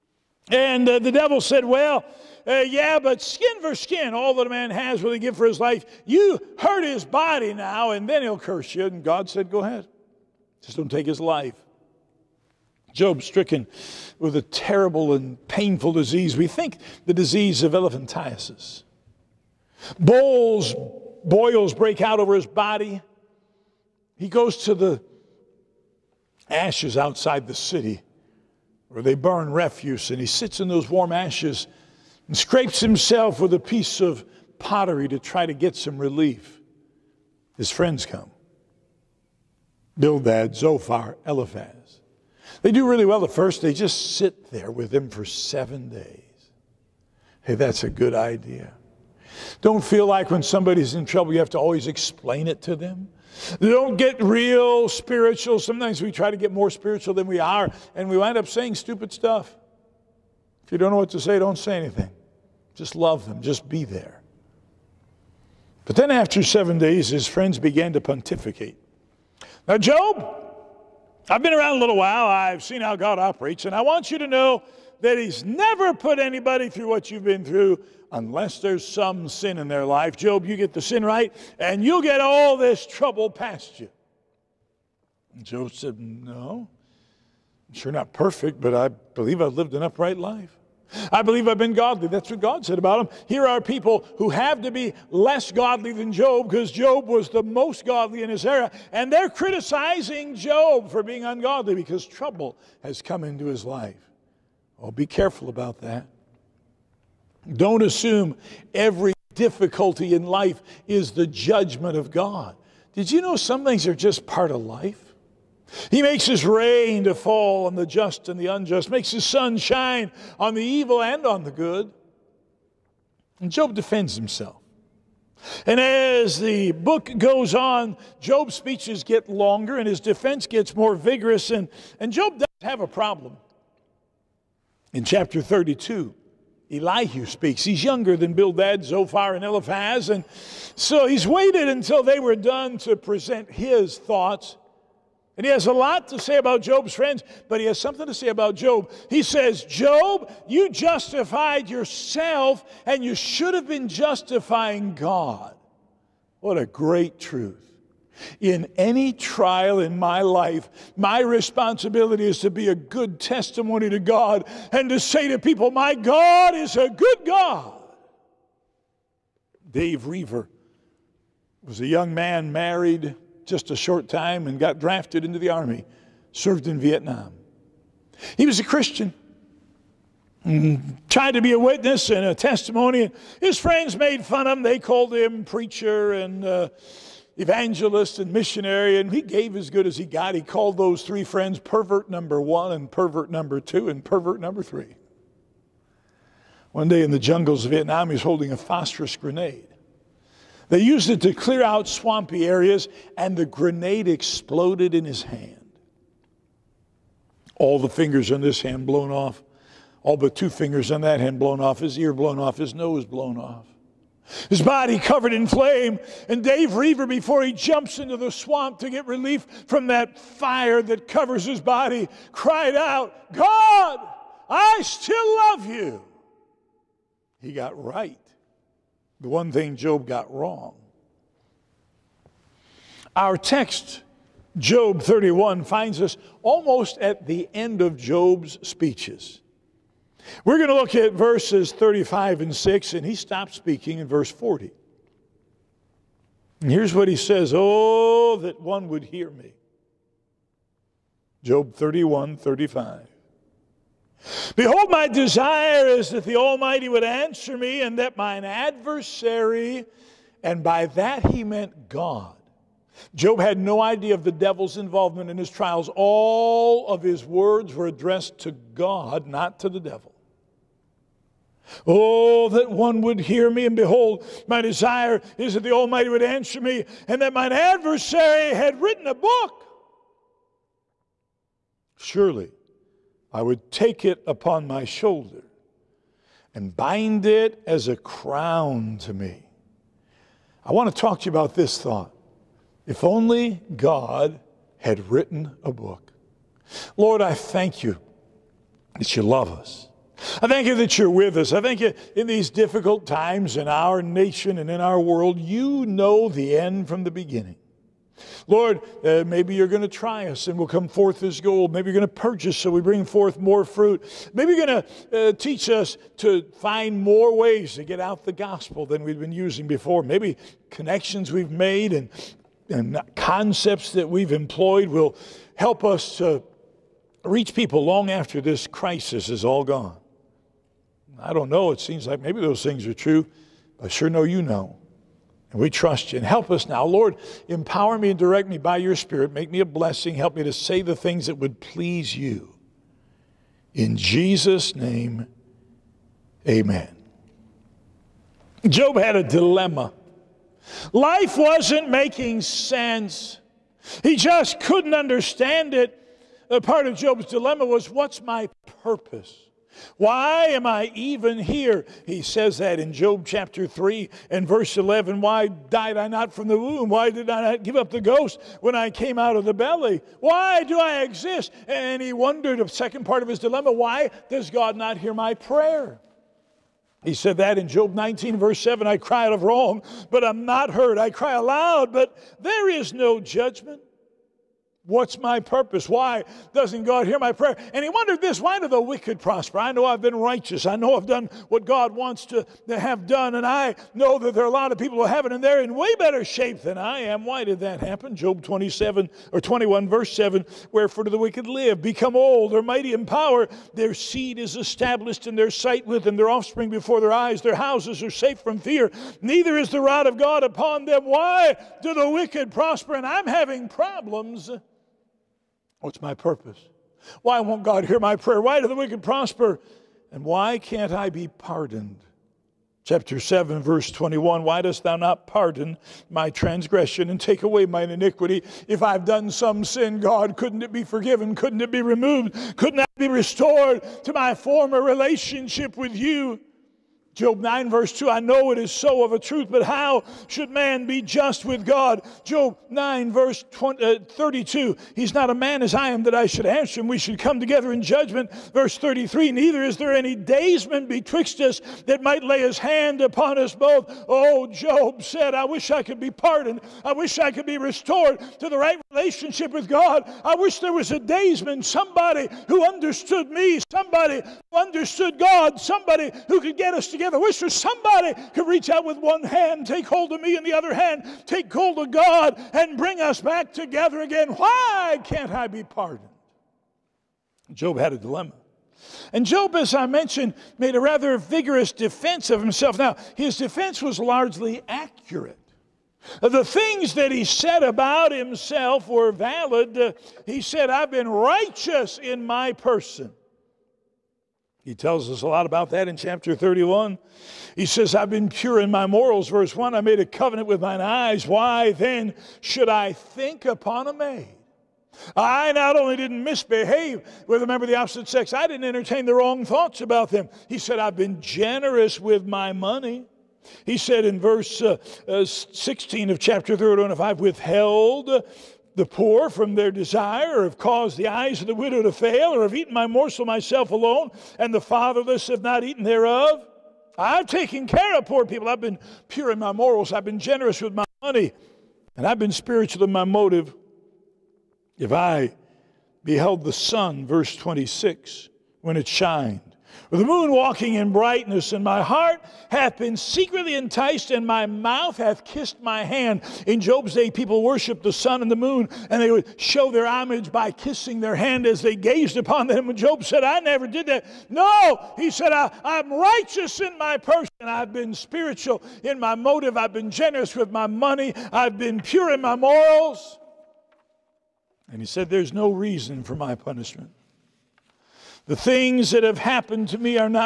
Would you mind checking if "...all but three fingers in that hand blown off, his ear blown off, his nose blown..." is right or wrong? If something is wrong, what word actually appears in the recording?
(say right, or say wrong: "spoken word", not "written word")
wrong: "two", not "three".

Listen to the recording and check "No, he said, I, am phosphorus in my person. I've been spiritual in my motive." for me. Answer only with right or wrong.
wrong.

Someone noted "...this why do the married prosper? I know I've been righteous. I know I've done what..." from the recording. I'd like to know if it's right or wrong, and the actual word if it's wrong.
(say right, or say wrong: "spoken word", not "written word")
wrong: "wicked", not "married".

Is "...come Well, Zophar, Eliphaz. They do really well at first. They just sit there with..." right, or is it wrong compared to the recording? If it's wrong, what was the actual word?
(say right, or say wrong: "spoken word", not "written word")
wrong: "Bildad", not "Well".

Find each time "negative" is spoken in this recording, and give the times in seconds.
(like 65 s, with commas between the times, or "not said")
not said.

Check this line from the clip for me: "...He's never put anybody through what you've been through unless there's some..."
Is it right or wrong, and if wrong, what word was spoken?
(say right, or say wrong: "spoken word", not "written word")
right.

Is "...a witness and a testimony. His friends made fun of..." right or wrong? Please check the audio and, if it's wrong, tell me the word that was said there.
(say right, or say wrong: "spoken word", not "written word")
right.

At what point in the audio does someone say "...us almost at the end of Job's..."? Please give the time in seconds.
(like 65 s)
235 s.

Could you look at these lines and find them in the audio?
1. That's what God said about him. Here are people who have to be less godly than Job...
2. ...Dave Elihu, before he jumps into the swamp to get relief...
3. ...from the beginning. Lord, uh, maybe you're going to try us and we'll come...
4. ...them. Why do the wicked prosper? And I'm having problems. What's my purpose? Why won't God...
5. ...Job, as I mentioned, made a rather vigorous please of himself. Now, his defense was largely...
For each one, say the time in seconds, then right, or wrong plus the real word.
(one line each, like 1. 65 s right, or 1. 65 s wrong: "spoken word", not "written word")
1. 92 s right
2. 216 s wrong: "Roever", not "Elihu"
3. 306 s right
4. 410 s right
5. 479 s wrong: "defense", not "please".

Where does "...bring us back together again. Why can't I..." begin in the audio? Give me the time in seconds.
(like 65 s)
472 s.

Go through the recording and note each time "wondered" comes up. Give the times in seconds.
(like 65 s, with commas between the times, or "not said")
372 s, 387 s.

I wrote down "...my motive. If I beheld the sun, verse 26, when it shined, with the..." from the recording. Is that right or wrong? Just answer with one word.
right.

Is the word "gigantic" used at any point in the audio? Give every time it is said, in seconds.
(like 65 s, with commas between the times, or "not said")
not said.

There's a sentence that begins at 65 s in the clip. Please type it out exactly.
But then after seven days, his friends began to pontificate.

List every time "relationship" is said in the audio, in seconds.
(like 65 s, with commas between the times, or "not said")
434 s, 458 s.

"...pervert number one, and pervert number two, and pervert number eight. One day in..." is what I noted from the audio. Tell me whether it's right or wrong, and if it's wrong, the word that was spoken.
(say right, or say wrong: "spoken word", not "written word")
wrong: "three", not "eight".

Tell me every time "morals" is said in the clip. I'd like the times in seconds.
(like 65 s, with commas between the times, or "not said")
498 s, 529 s, 562 s.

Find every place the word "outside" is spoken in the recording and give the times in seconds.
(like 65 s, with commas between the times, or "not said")
26 s.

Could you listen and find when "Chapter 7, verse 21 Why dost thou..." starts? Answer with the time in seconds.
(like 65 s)
422 s.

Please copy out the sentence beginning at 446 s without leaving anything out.
We should come together in judgment.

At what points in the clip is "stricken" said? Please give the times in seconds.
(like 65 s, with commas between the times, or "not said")
13 s.